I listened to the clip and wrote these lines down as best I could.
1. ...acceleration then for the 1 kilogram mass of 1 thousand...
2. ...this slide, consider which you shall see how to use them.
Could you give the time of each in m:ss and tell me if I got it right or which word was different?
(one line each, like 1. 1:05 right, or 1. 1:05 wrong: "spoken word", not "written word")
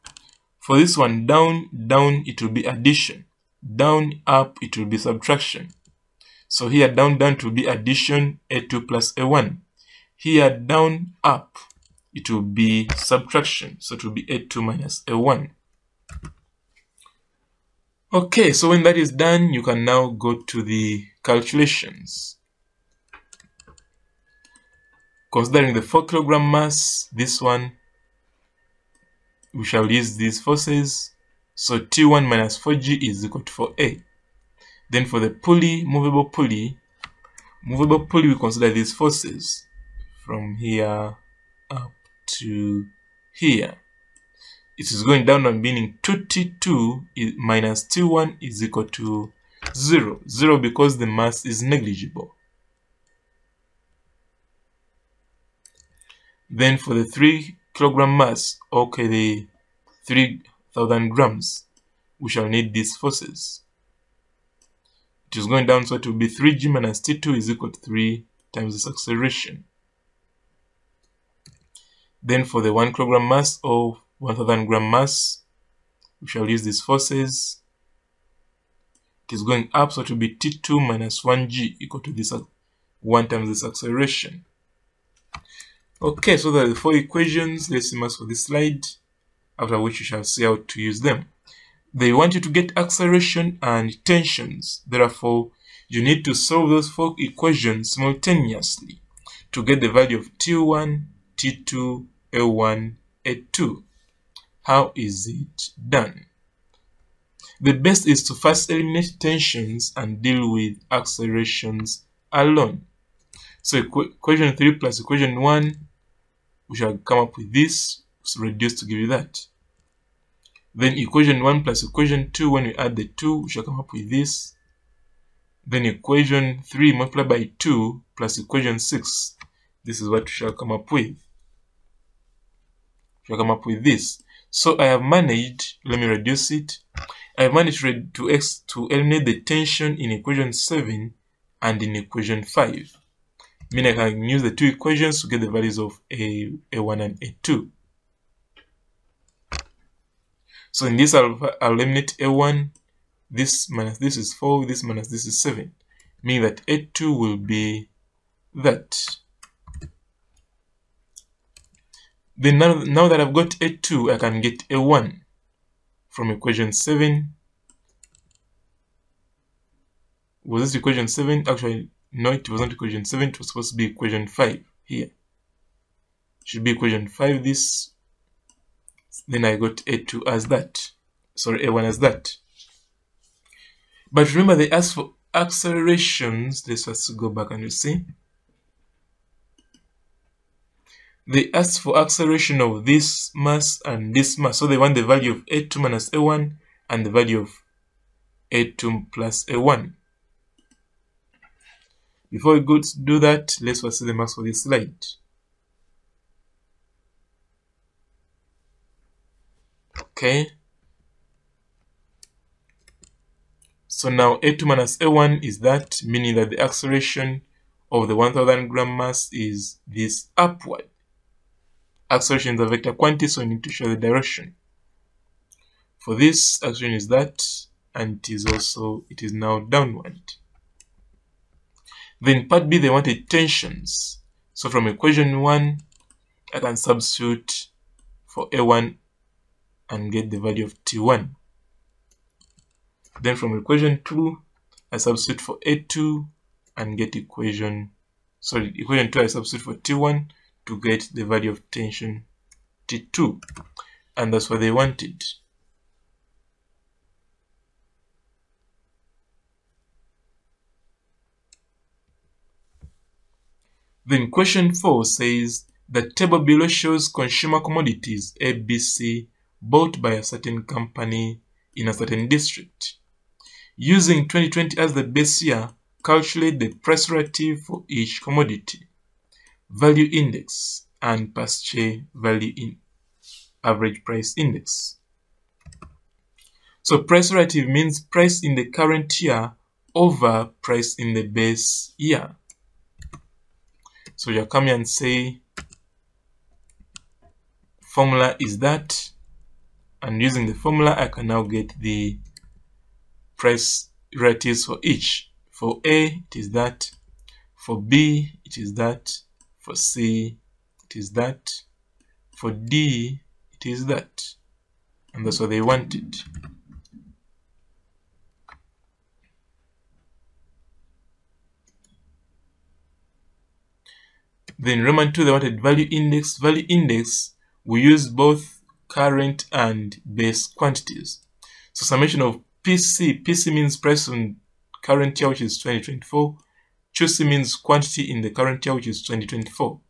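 1. 1:08 right
2. 1:28 wrong: "after", not "consider".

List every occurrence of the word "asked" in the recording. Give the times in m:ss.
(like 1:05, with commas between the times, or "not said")
3:04, 3:11.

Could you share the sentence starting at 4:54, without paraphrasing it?
So you come here and say formula is that and using the formula I can now get the price relatives for each.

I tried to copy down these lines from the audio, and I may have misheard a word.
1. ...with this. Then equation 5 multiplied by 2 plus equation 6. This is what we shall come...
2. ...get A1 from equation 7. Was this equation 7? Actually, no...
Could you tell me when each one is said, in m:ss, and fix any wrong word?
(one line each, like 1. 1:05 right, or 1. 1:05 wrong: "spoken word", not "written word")
1. 2:03 wrong: "3", not "5"
2. 2:44 right.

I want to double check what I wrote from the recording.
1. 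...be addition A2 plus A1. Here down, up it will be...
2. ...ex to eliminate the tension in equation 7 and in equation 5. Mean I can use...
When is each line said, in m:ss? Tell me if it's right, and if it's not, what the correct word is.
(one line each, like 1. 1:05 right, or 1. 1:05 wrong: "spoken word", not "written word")
1. 0:07 right
2. 2:18 right.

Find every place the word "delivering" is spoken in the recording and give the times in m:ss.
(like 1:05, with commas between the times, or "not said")
not said.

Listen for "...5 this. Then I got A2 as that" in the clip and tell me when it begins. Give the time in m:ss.
2:57.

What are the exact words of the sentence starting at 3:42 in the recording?
Acceleration is a vector quantity, so we need to show the direction.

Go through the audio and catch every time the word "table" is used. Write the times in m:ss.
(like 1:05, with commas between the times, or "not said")
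4:26.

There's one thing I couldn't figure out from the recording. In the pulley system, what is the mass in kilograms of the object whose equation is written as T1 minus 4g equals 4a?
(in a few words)
4 kilograms.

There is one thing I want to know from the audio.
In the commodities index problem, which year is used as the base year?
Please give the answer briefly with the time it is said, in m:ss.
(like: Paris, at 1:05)
2020, at 4:34.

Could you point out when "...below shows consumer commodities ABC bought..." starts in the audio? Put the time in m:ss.
4:26.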